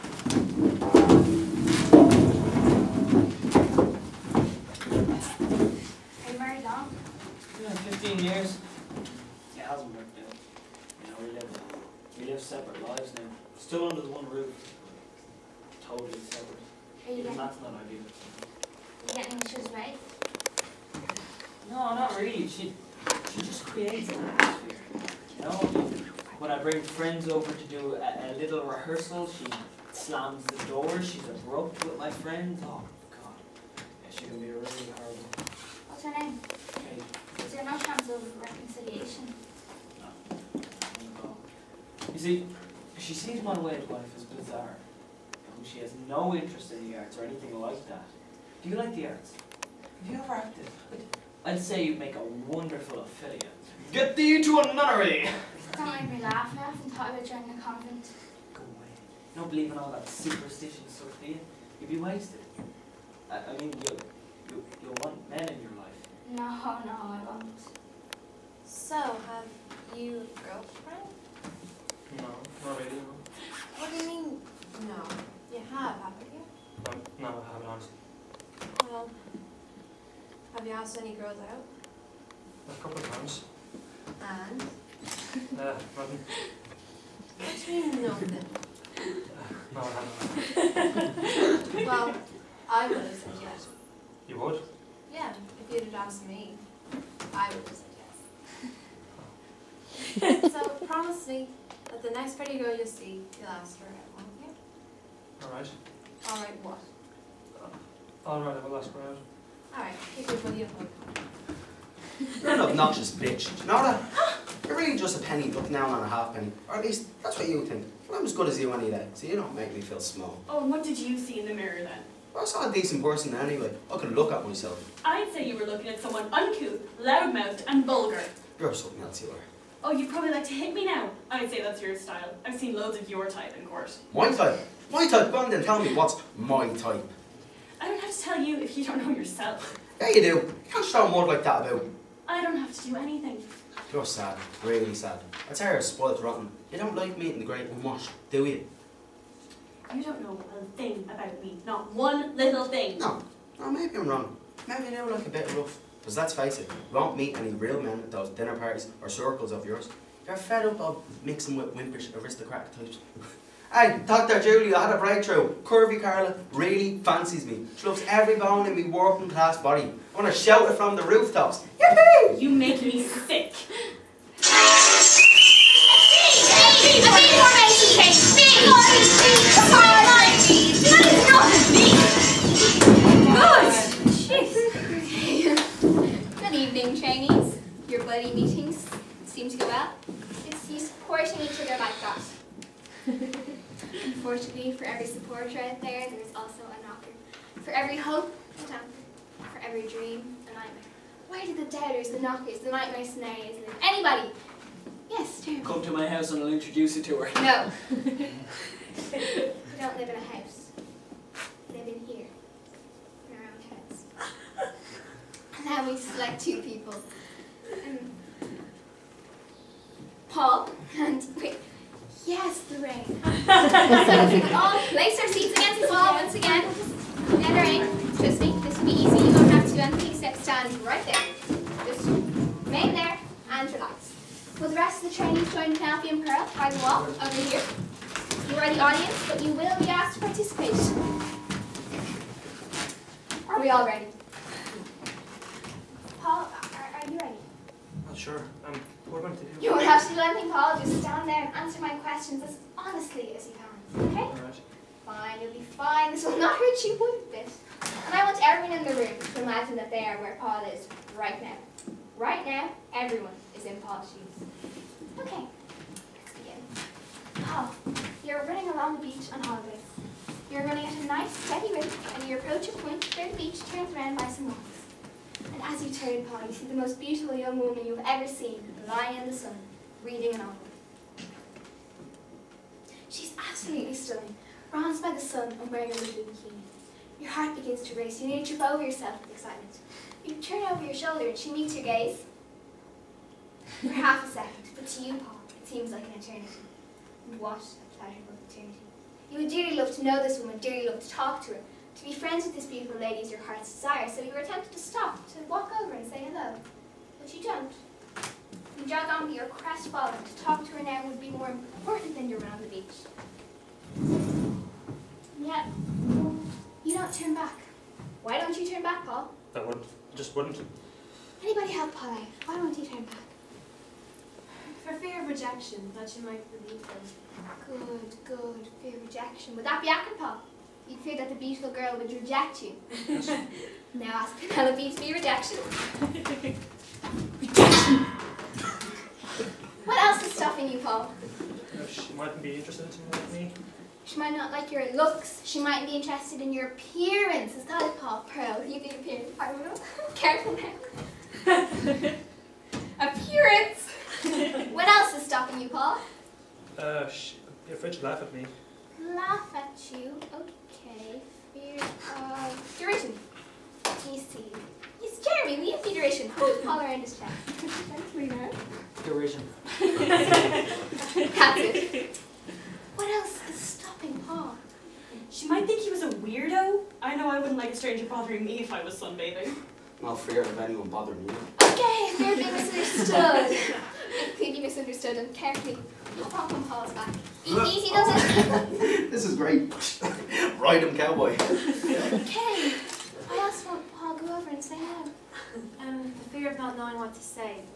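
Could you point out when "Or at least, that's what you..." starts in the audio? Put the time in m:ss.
1:56.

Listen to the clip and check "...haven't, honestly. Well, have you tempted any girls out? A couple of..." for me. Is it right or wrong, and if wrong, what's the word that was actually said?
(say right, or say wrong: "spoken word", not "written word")
wrong: "asked", not "tempted".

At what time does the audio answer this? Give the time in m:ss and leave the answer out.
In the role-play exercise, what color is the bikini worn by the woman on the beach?
4:45.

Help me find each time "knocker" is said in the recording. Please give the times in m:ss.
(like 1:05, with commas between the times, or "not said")
3:16, 3:22.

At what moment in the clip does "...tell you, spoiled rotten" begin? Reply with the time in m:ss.
2:25.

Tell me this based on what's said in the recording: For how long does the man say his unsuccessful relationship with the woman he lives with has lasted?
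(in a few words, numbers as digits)
15 years.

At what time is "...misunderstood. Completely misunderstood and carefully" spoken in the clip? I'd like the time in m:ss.
6:22.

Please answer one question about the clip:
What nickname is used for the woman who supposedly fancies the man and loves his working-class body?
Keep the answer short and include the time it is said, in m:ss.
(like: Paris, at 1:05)
Curvy Carla, at 2:45.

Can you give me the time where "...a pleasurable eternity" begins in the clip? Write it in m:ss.
4:57.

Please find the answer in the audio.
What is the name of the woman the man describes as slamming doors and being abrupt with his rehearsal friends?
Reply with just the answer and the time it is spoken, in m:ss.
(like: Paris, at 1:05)
Kate, at 0:36.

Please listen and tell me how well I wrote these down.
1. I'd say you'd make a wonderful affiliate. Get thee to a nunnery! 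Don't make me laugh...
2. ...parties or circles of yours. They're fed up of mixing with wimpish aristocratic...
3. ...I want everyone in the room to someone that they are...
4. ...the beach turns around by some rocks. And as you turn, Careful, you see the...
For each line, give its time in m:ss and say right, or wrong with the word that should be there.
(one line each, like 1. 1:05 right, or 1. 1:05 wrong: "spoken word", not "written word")
1. 0:51 right
2. 2:38 right
3. 4:18 wrong: "imagine", not "someone"
4. 4:33 wrong: "Paul", not "Careful".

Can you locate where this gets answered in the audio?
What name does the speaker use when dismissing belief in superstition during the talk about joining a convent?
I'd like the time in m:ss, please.
1:00.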